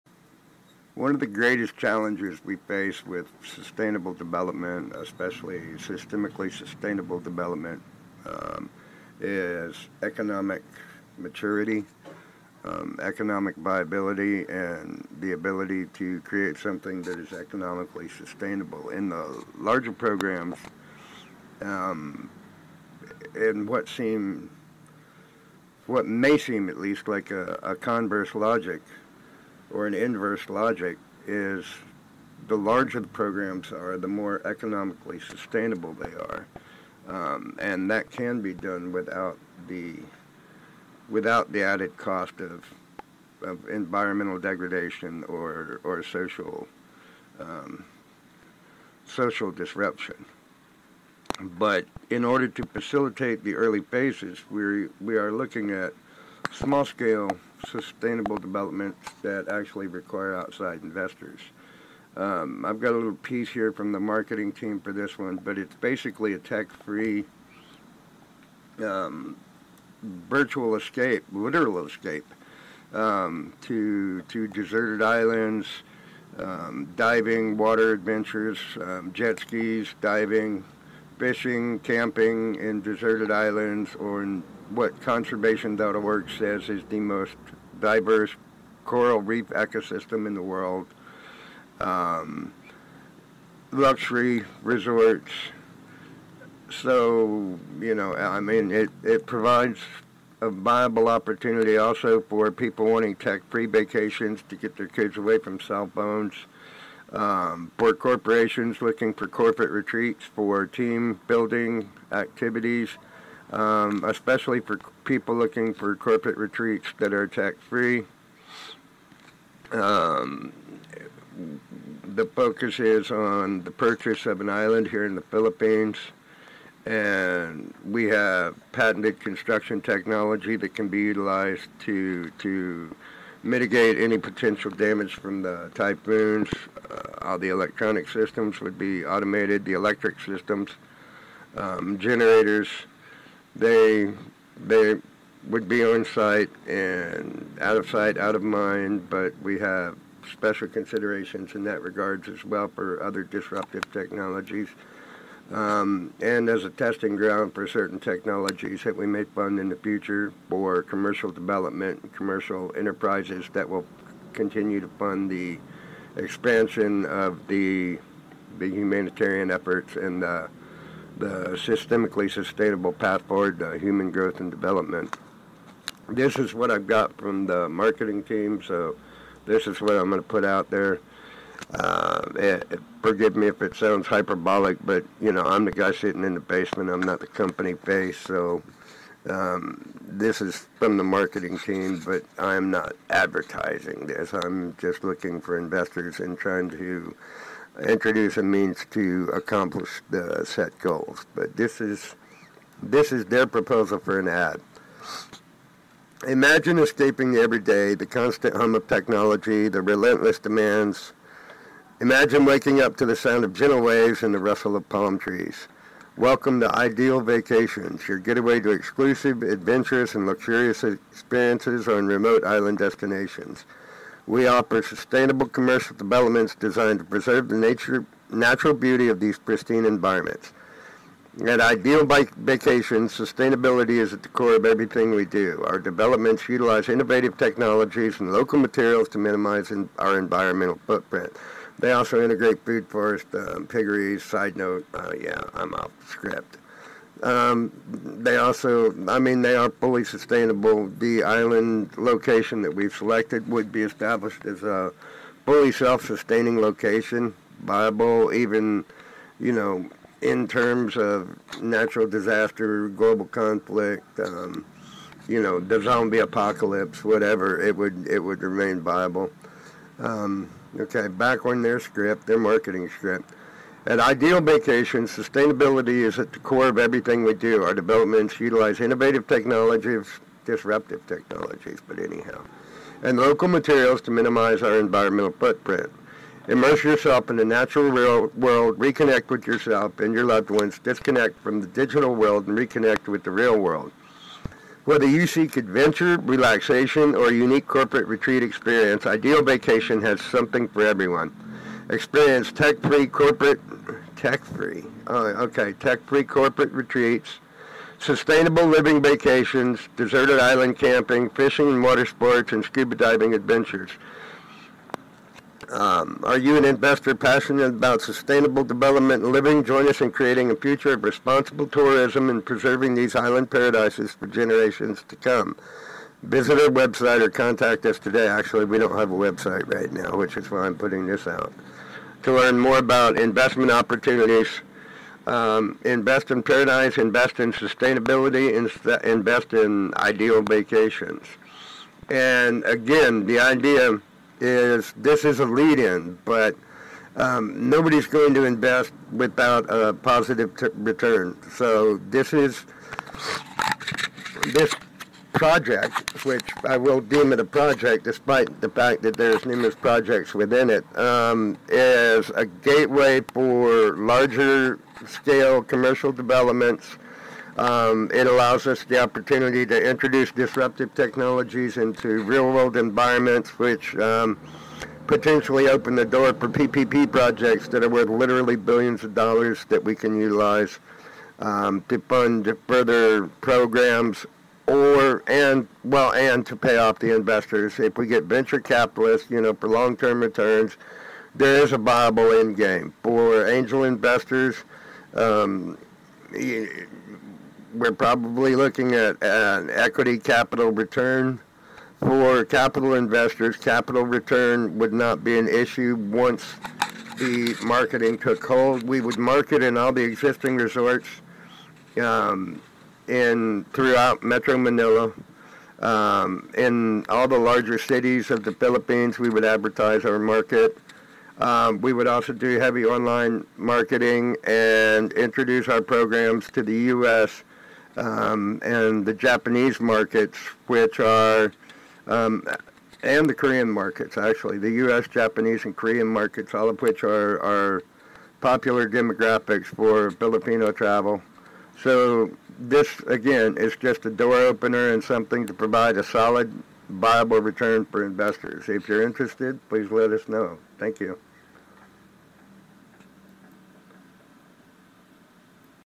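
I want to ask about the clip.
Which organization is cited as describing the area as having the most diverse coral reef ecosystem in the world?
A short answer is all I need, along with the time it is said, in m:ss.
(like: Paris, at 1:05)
conservation.org, at 1:25.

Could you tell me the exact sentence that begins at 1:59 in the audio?
Um, the focus is on the purchase of an island here in the Philippines.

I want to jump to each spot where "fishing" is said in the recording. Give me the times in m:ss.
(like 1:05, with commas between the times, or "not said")
1:21, 5:11.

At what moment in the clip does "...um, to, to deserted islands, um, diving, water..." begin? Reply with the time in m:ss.
1:12.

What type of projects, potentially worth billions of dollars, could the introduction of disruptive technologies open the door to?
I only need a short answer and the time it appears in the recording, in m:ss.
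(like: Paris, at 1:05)
PPP projects, at 6:16.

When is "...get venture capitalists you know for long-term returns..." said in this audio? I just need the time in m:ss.
6:28.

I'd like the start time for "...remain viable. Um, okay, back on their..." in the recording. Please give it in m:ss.
4:28.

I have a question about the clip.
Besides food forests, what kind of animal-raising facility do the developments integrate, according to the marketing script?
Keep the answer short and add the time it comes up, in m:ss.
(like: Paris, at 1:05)
piggeries, at 4:03.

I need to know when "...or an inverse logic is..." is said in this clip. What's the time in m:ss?
0:29.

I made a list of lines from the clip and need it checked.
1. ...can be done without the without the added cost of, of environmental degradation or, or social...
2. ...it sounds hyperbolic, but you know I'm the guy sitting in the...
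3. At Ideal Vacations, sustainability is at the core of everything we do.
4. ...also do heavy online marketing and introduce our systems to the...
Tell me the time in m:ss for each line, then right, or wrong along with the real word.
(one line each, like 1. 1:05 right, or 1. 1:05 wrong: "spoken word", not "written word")
1. 0:38 right
2. 3:03 right
3. 3:51 right
4. 7:02 wrong: "programs", not "systems".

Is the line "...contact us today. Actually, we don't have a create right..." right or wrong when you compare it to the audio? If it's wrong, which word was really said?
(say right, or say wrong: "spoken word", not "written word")
wrong: "website", not "create".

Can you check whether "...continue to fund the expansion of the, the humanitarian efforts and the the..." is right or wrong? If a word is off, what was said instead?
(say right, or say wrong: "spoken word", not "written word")
right.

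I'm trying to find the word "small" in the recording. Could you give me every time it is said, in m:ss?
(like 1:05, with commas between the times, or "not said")
0:56.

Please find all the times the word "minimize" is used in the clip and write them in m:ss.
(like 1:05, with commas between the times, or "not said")
3:59, 4:44.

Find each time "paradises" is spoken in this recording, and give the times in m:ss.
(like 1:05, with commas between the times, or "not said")
5:23, 5:36.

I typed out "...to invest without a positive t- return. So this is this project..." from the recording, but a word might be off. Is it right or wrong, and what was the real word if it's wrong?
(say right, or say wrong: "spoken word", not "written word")
right.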